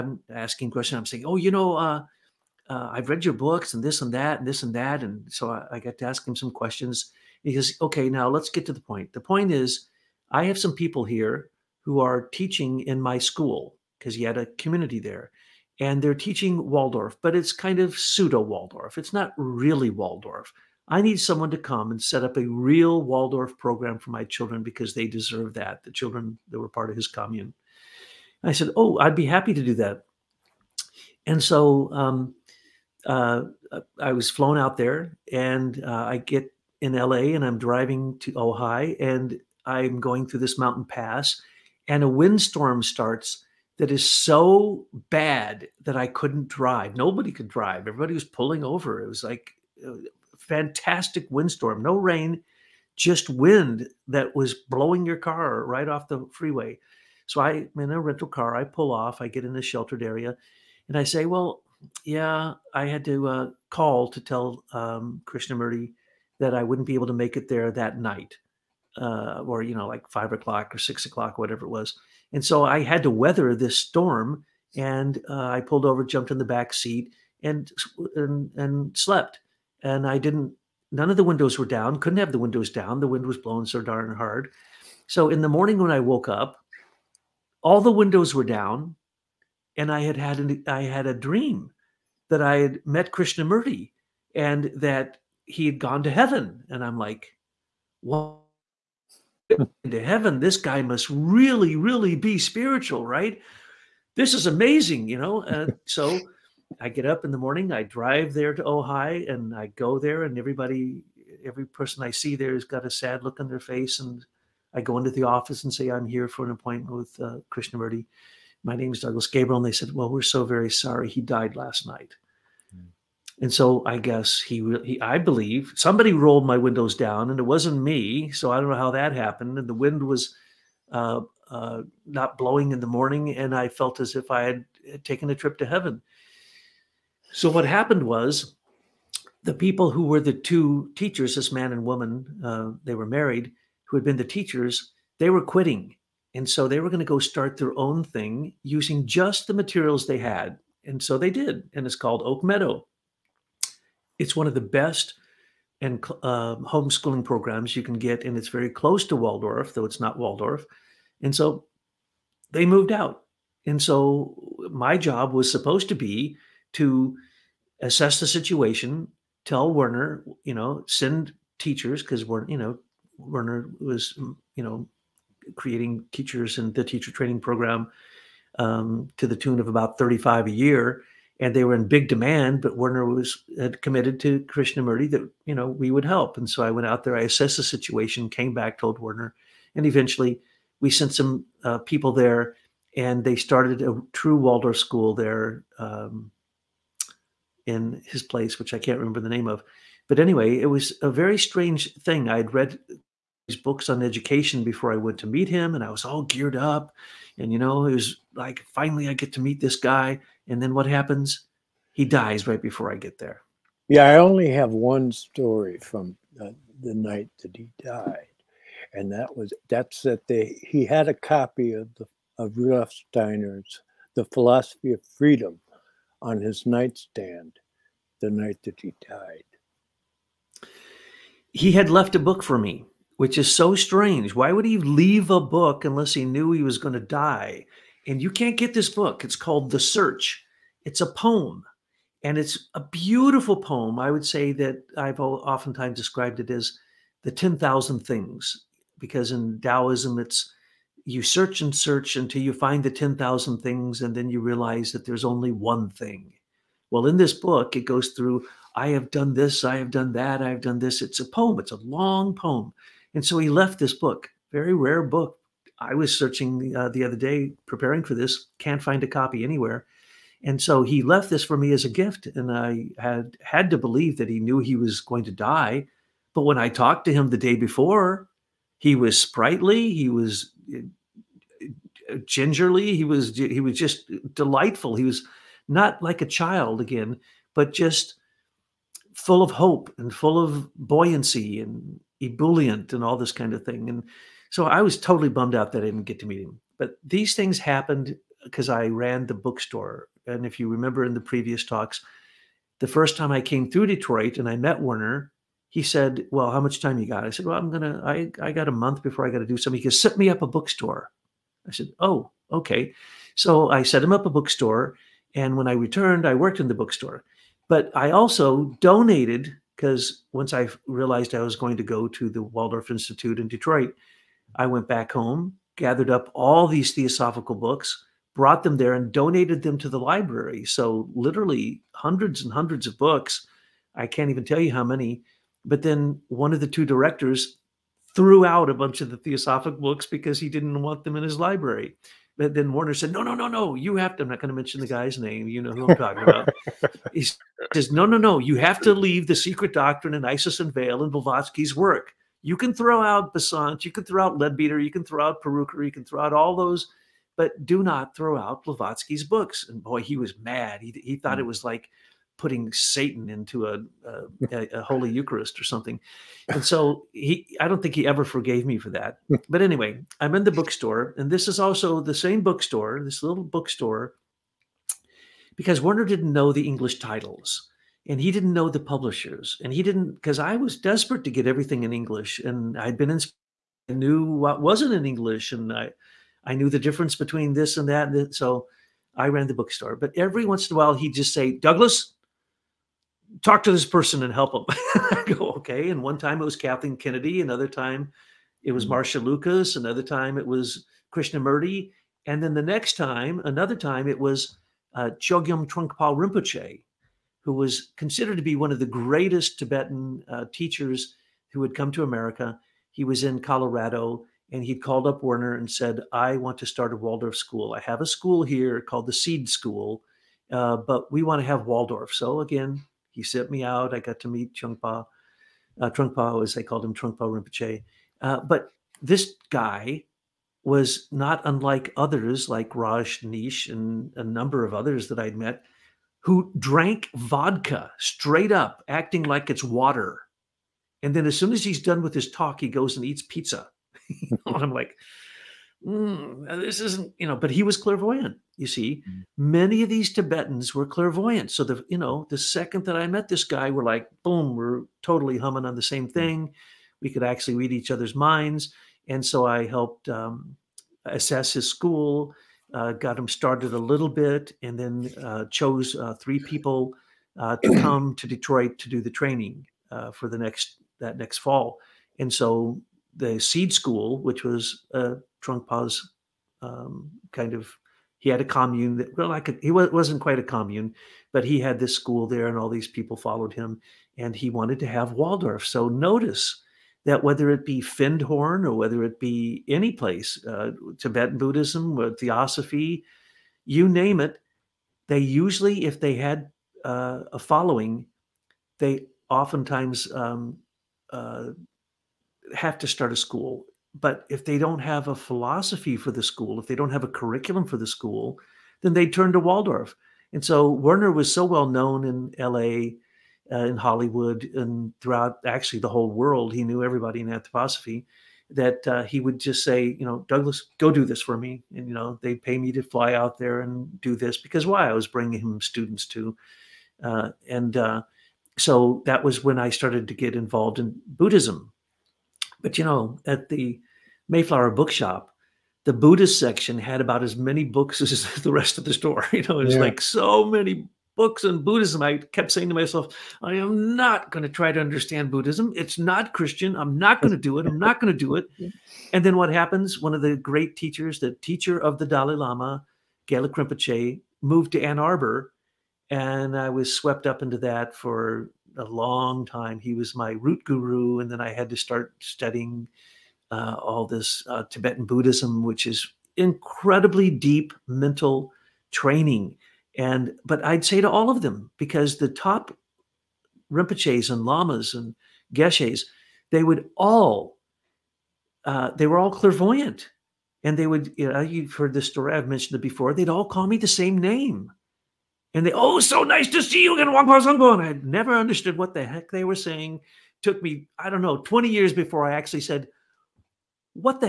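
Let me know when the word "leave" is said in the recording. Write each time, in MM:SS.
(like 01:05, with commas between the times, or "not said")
03:54, 05:48.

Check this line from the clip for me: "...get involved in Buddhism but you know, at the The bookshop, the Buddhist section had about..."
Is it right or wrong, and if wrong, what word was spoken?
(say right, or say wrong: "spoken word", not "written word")
wrong: "Mayflower", not "The".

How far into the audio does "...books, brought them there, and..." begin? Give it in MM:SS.
05:27.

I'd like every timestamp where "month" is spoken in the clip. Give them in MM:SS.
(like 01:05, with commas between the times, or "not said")
05:08.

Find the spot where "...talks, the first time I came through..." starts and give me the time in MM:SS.
05:01.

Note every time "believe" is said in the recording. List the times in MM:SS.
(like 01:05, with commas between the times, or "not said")
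02:05, 04:33.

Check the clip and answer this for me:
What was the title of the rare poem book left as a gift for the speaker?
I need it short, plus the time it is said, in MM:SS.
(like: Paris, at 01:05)
The Search, at 03:59.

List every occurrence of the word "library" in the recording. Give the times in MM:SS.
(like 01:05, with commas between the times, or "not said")
05:29, 05:41.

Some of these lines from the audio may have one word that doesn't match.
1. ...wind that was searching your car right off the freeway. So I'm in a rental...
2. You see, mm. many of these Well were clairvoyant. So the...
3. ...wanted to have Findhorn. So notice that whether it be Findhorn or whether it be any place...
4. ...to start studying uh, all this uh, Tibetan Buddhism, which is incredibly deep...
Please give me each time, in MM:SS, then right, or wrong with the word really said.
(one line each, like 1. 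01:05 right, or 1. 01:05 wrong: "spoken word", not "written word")
1. 00:53 wrong: "blowing", not "searching"
2. 07:28 wrong: "Tibetans", not "Well"
3. 08:04 wrong: "Waldorf", not "Findhorn"
4. 09:21 right.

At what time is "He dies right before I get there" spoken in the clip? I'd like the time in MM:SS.
03:31.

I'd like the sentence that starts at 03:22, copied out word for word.
i had read these books on education before I went to meet him, and I was all geared up.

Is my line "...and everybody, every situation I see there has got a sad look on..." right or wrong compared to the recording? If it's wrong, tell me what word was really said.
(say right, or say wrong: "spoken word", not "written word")
wrong: "person", not "situation".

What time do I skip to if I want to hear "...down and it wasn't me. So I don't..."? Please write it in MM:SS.
02:06.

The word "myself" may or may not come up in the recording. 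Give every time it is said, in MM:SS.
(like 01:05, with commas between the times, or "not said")
09:02.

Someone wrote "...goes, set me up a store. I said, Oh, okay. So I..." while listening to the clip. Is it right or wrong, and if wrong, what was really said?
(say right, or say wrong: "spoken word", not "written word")
wrong: "bookstore", not "store".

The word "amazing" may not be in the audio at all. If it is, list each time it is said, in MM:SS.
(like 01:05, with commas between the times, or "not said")
01:44.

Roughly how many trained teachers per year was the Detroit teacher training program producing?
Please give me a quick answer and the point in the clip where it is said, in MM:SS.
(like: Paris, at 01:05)
35, at 02:59.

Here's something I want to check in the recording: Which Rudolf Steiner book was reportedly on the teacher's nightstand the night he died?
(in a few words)
The Philosophy of Freedom.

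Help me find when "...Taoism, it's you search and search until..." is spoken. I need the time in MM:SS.
04:09.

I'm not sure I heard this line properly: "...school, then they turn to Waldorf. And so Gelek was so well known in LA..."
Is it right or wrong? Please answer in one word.
wrong.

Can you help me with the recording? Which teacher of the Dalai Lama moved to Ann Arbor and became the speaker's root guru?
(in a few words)
Gelek Rinpoche.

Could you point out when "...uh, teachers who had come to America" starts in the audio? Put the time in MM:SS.
06:50.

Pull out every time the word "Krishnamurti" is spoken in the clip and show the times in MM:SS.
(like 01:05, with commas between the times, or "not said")
01:05, 01:33, 01:57, 03:04, 06:41.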